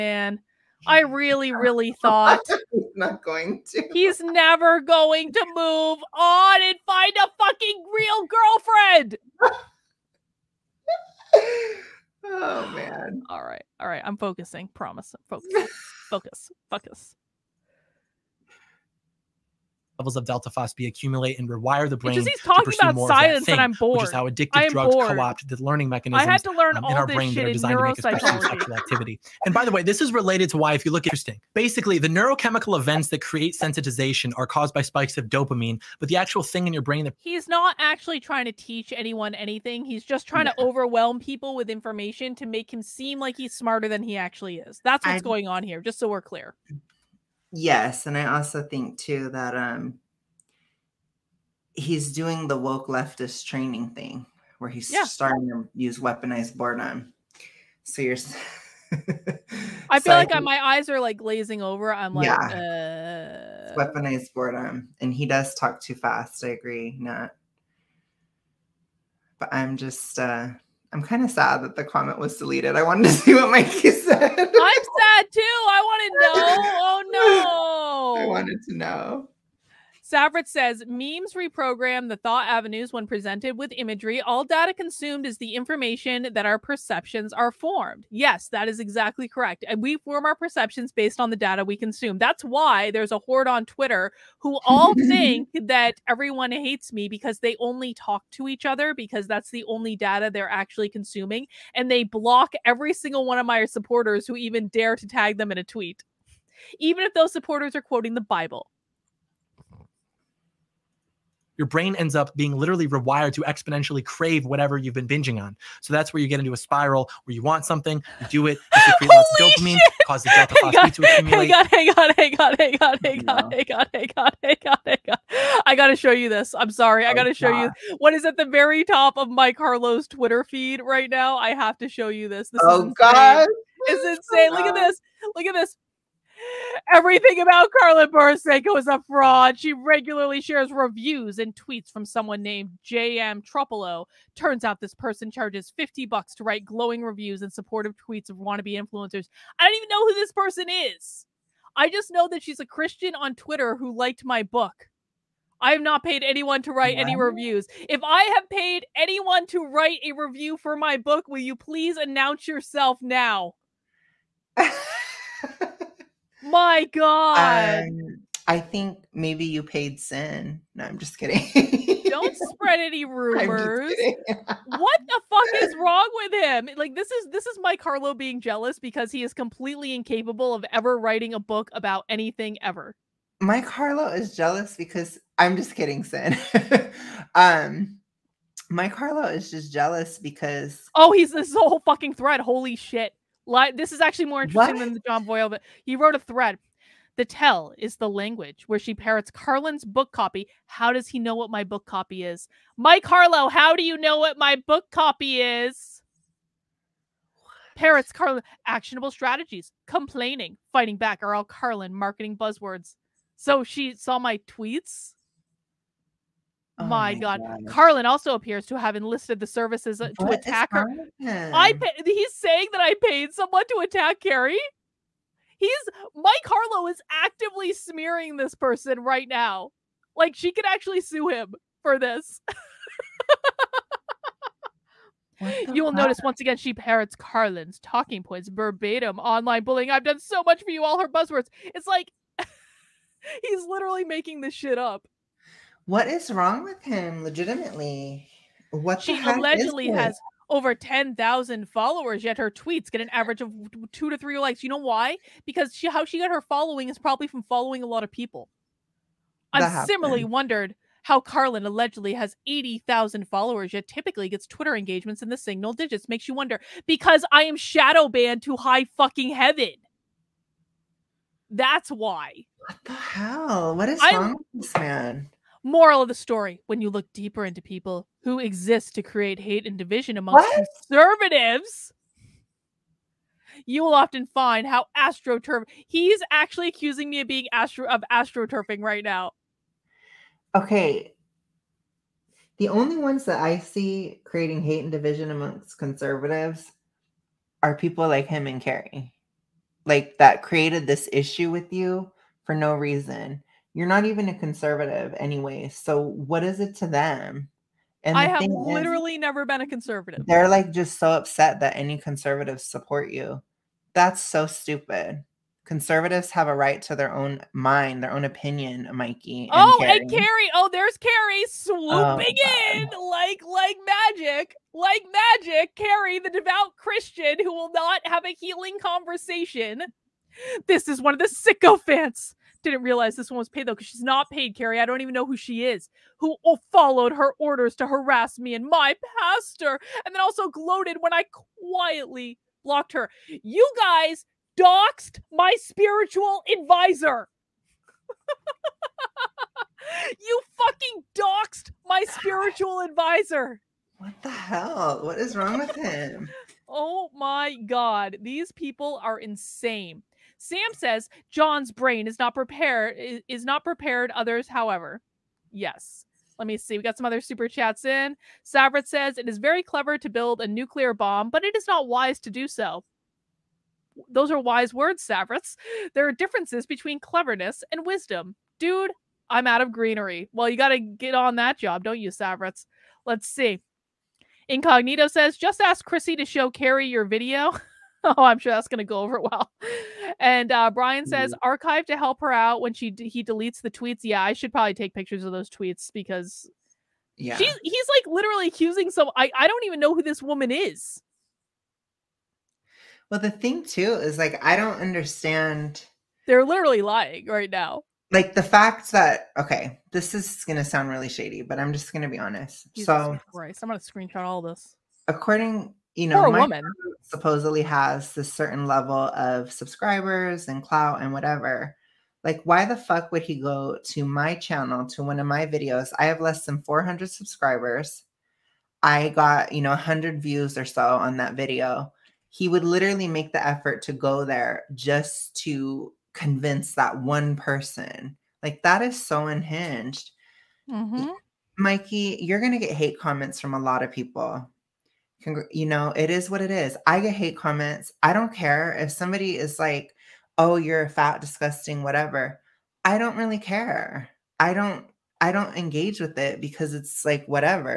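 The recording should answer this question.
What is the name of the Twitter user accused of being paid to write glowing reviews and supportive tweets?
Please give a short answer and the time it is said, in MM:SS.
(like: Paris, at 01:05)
J.M. Tropolo, at 02:22.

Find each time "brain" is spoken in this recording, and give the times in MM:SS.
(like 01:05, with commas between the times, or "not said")
00:21, 00:27, 00:36, 01:51, 06:01.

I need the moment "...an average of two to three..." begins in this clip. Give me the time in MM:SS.
04:13.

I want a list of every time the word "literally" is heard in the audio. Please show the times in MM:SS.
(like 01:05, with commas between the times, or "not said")
01:52, 04:03, 05:08, 06:38, 06:46, 07:12.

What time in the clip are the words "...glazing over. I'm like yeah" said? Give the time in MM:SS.
01:01.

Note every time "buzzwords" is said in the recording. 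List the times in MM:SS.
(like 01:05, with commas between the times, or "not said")
03:32, 04:01.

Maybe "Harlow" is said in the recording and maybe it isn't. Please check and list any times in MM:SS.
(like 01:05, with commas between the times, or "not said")
02:57, 03:03, 03:08, 03:23, 03:46.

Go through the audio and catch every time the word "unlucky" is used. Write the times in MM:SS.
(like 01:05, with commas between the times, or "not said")
not said.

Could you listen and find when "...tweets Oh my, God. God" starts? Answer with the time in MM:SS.
03:34.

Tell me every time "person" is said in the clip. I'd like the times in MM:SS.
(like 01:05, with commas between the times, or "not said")
02:24, 02:30, 03:48, 07:17.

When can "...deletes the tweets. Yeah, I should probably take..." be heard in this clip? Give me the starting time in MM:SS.
06:33.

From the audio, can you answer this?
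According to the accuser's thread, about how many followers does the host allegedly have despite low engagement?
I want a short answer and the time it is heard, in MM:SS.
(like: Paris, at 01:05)
80,000, at 04:22.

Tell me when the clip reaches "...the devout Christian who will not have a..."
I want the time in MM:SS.
05:26.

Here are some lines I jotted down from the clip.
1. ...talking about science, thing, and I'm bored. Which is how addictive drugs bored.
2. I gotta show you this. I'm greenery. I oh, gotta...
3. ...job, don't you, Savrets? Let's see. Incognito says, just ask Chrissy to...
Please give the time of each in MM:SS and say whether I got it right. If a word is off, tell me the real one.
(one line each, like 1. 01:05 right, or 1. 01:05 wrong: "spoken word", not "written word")
1. 00:22 right
2. 02:05 wrong: "sorry", not "greenery"
3. 06:21 right.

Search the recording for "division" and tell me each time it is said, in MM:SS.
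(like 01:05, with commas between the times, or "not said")
04:39, 04:54.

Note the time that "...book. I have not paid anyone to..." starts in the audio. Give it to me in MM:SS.
02:34.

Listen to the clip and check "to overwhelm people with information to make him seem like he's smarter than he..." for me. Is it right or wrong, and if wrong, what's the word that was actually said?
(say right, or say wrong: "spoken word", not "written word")
right.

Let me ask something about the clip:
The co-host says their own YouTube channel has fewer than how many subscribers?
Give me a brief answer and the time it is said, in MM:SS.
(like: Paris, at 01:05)
400, at 07:06.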